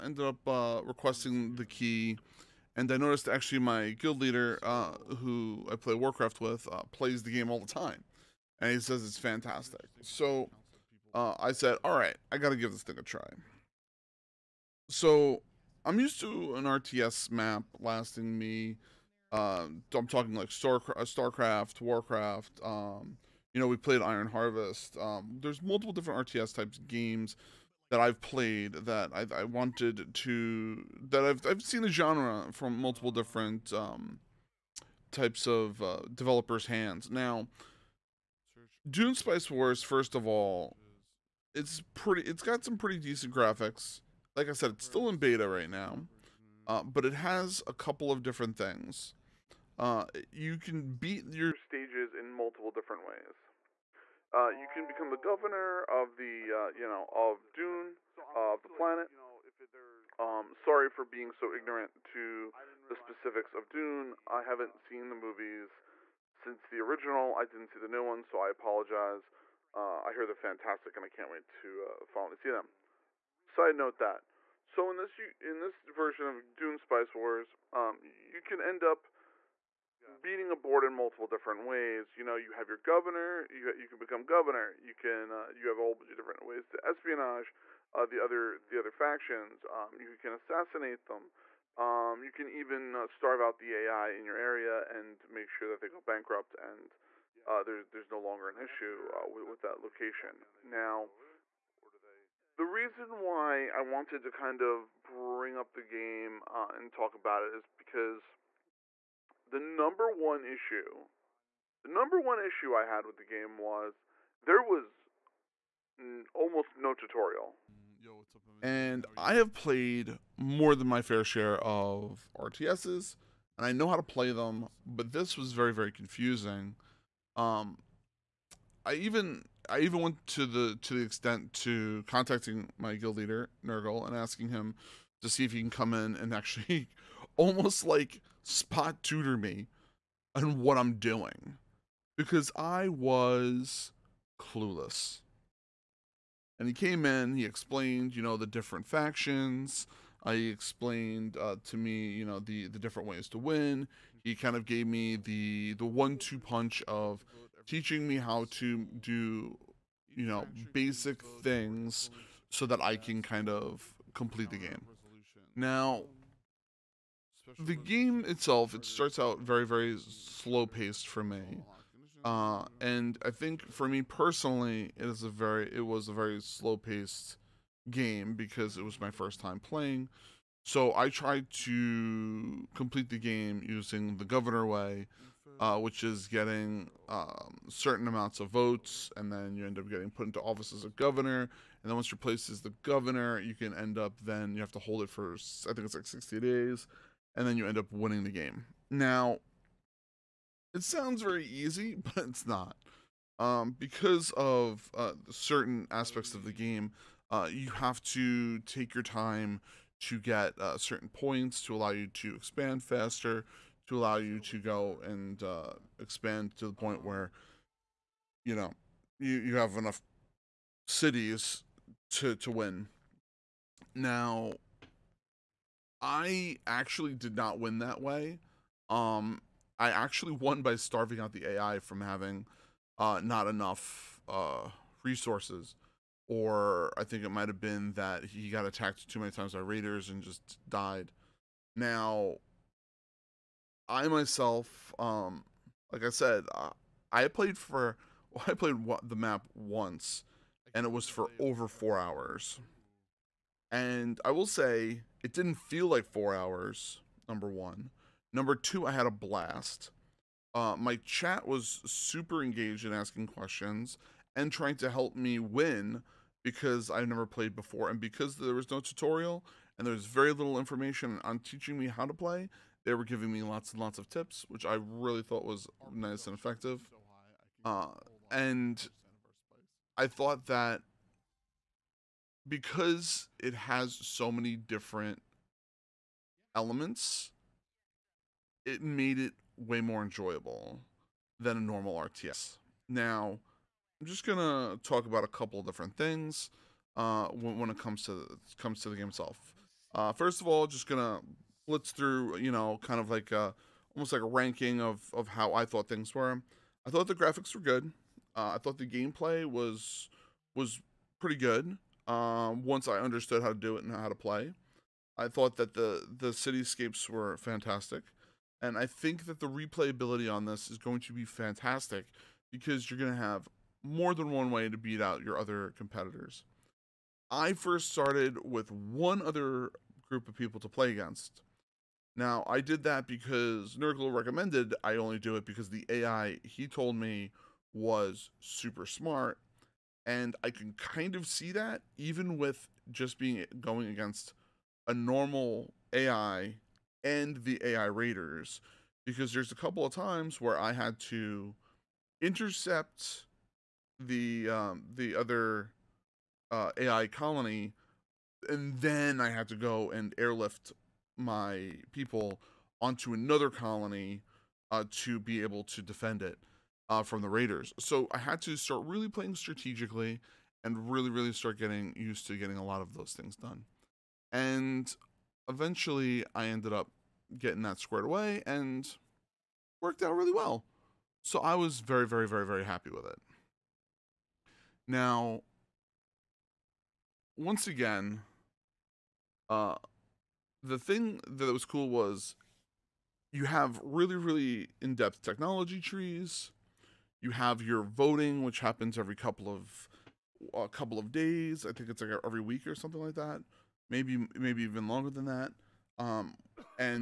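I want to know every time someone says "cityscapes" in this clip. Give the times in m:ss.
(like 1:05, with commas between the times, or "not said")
5:16.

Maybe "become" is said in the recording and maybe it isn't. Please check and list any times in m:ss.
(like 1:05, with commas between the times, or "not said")
0:54, 1:23.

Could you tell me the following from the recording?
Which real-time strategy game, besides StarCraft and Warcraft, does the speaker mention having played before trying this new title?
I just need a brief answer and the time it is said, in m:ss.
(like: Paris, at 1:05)
Iron Harvest, at 0:23.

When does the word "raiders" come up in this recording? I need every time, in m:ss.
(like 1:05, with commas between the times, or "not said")
3:59, 5:47, 6:07.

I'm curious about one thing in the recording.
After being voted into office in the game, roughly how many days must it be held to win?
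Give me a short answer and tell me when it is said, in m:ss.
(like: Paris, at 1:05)
60, at 3:16.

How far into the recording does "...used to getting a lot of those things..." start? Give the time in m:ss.
6:11.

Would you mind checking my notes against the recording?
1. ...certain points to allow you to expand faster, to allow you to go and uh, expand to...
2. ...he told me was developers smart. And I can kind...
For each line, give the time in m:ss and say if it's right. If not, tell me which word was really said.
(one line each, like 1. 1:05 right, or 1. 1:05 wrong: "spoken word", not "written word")
1. 3:30 right
2. 5:36 wrong: "super", not "developers".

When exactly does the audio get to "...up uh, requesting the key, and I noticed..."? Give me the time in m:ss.
0:00.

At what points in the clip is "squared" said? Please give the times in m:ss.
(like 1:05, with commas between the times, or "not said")
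6:17.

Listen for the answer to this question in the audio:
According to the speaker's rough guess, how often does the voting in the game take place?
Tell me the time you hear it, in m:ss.
6:42.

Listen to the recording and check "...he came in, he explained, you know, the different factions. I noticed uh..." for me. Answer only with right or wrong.
wrong.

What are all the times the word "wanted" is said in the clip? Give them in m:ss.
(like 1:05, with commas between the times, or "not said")
0:29, 1:43.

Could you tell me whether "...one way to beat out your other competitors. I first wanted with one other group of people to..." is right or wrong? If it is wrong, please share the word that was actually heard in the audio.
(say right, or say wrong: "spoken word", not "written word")
wrong: "started", not "wanted".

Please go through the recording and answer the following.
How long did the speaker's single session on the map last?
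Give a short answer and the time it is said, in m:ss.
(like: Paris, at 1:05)
over four hours, at 4:11.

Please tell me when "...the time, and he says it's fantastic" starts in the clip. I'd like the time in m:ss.
0:07.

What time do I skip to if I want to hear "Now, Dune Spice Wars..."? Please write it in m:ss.
0:37.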